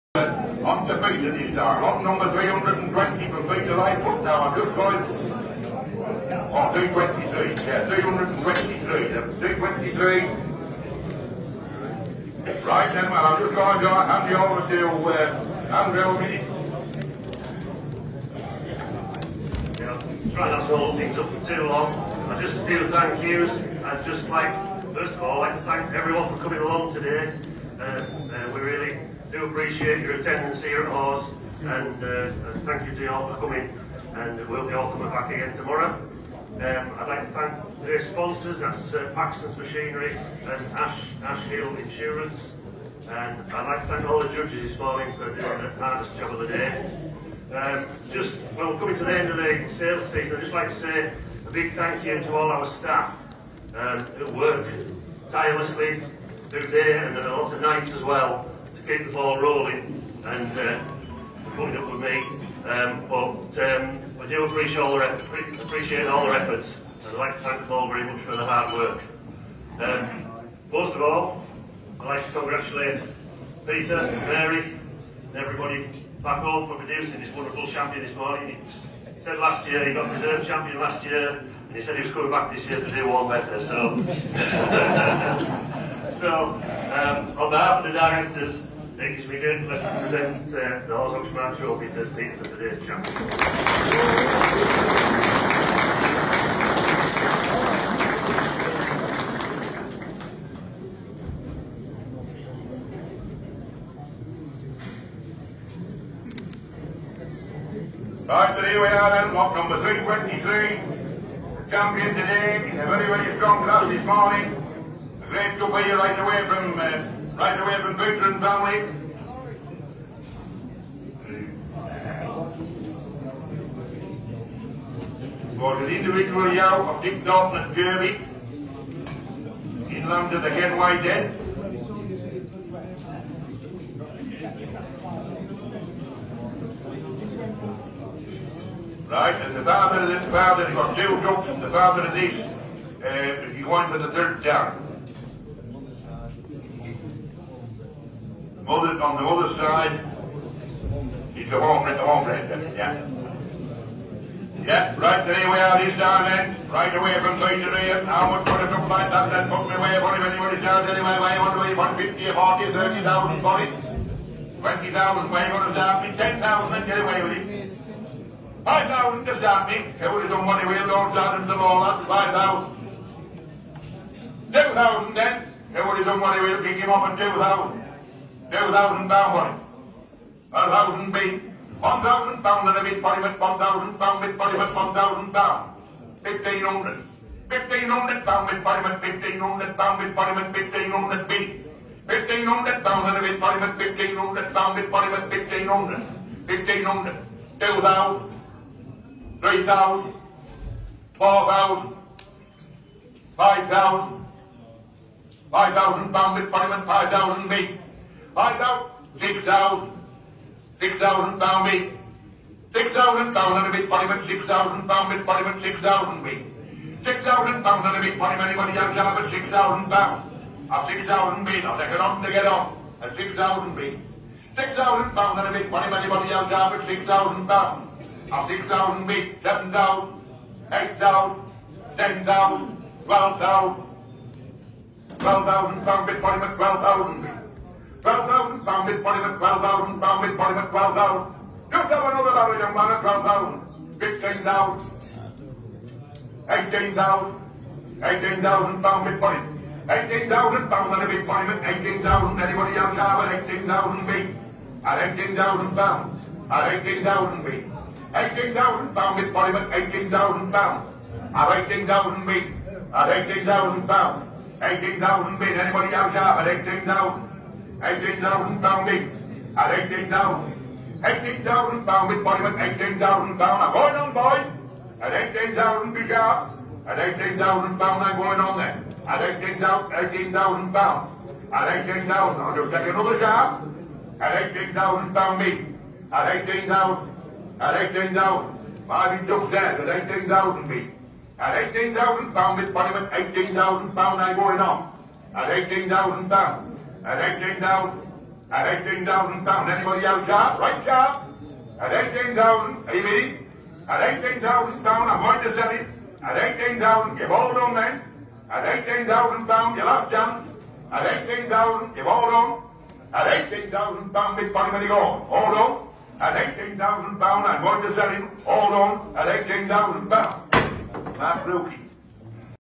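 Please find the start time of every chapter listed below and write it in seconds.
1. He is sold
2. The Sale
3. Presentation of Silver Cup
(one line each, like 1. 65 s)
1. 300 s
2. 85 s
3. 60 s.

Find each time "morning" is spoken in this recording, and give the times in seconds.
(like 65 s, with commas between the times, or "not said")
44 s, 78 s, 114 s.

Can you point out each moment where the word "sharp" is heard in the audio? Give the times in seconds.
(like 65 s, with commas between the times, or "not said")
276 s, 283 s.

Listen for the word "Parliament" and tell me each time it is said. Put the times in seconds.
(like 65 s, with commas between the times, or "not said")
272 s, 292 s.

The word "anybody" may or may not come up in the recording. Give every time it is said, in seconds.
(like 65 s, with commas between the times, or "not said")
160 s, 218 s, 225 s, 252 s, 265 s, 299 s.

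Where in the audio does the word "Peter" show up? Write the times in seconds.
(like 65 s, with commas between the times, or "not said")
3 s, 73 s.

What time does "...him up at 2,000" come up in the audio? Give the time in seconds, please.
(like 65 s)
176 s.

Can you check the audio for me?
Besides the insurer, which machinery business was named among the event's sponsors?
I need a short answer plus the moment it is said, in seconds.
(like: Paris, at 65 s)
Paxton's Machinery, at 39 s.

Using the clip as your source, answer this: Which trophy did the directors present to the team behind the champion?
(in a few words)
Horse Oaks Man Trophy.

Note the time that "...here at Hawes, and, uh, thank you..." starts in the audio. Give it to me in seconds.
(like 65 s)
30 s.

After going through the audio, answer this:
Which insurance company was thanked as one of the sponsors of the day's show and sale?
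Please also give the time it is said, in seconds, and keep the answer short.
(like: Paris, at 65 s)
Ash Hill Insurance, at 41 s.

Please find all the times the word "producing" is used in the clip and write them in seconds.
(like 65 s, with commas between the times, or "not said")
76 s.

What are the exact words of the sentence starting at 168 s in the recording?
5,000 just down me, there would have done money with will all and all that.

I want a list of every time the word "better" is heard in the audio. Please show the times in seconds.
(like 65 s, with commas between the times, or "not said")
83 s.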